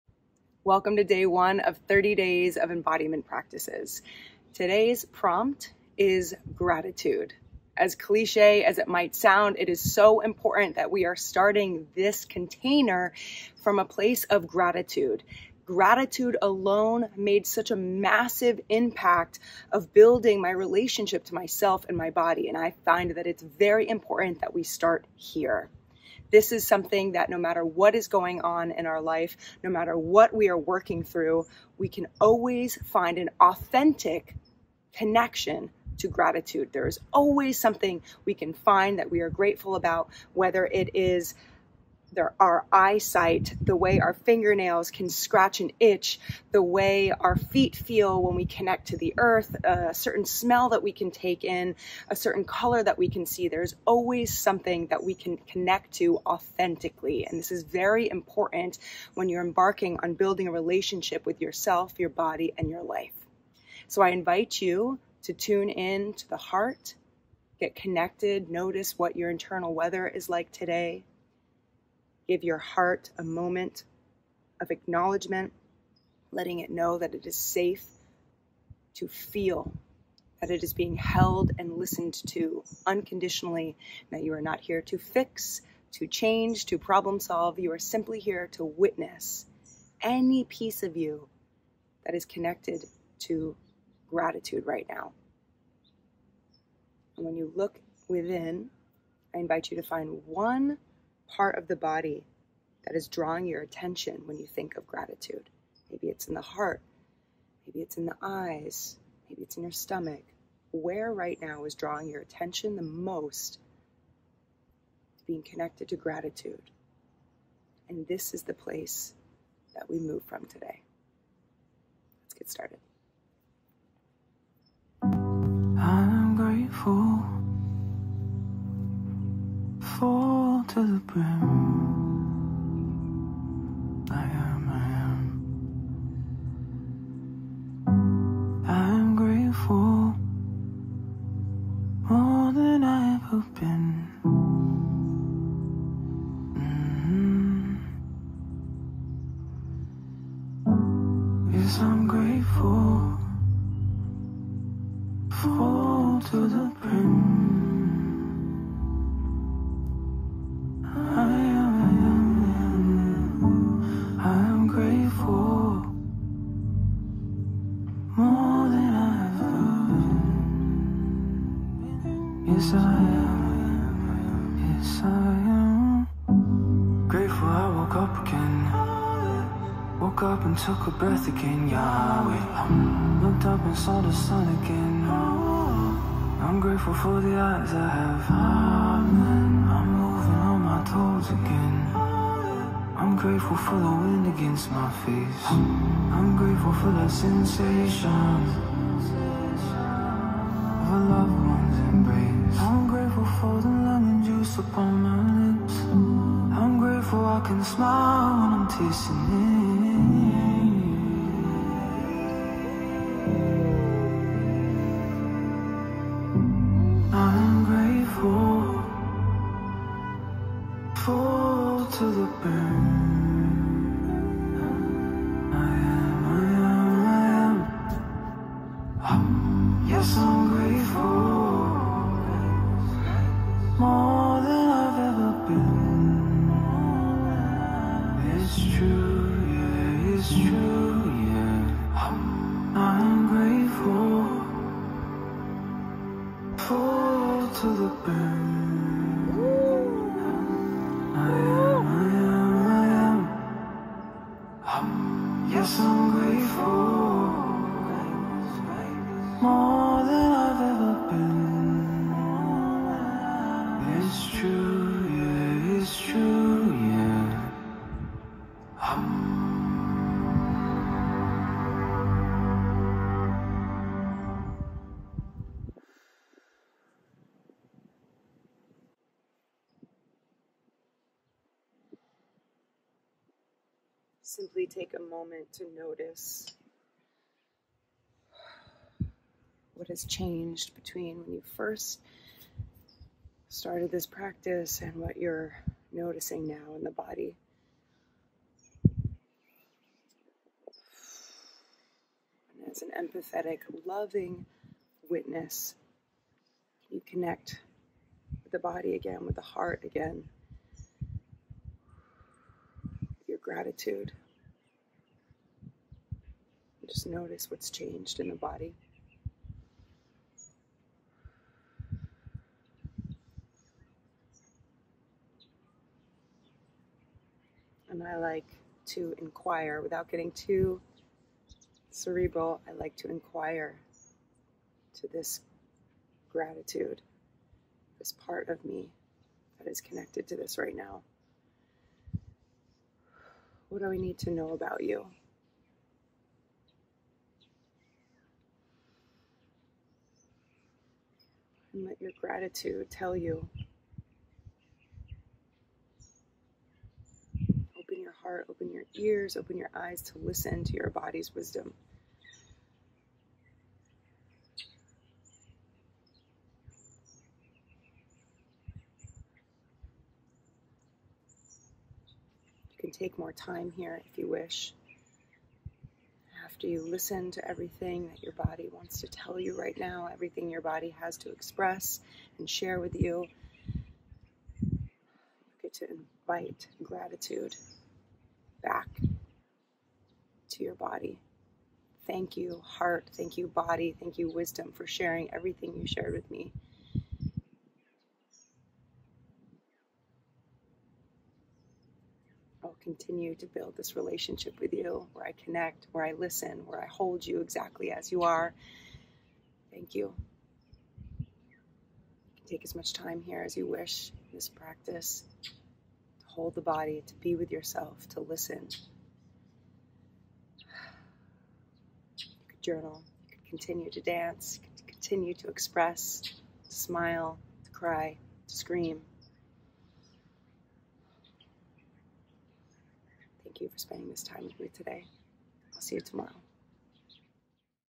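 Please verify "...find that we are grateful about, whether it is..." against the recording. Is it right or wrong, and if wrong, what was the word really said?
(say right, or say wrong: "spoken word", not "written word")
right.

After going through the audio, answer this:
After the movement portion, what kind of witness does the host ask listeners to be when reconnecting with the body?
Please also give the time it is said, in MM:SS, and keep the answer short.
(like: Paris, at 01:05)
empathetic, loving witness, at 05:02.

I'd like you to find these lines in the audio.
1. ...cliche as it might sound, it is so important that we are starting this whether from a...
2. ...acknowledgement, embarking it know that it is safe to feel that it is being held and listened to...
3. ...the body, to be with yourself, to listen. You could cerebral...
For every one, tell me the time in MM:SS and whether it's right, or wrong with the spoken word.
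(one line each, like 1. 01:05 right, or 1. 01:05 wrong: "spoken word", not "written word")
1. 00:07 wrong: "container", not "whether"
2. 01:14 wrong: "letting", not "embarking"
3. 06:56 wrong: "journal", not "cerebral".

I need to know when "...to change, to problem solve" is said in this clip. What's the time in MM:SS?
01:25.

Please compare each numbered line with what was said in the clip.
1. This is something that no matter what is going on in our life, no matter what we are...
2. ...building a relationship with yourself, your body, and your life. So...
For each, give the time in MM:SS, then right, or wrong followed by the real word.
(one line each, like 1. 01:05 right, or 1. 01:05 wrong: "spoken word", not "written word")
1. 00:26 right
2. 01:00 right.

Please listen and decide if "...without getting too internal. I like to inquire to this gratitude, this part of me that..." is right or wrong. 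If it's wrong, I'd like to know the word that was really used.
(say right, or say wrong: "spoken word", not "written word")
wrong: "cerebral", not "internal".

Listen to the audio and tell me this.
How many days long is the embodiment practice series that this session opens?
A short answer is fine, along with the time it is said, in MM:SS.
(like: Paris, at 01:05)
30, at 00:01.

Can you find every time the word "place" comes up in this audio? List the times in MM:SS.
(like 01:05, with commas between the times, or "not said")
00:13, 01:58.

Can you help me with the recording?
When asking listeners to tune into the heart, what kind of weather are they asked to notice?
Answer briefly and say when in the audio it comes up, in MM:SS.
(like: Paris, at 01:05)
internal weather, at 01:09.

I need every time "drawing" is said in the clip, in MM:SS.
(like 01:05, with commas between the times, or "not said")
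01:43, 01:51.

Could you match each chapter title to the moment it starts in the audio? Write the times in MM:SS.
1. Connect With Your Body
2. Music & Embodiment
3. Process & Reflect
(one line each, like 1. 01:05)
1. 01:04
2. 02:04
3. 04:38.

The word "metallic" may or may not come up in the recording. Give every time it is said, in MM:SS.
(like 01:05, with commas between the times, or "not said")
not said.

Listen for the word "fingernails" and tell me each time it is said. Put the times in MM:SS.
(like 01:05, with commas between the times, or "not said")
00:44.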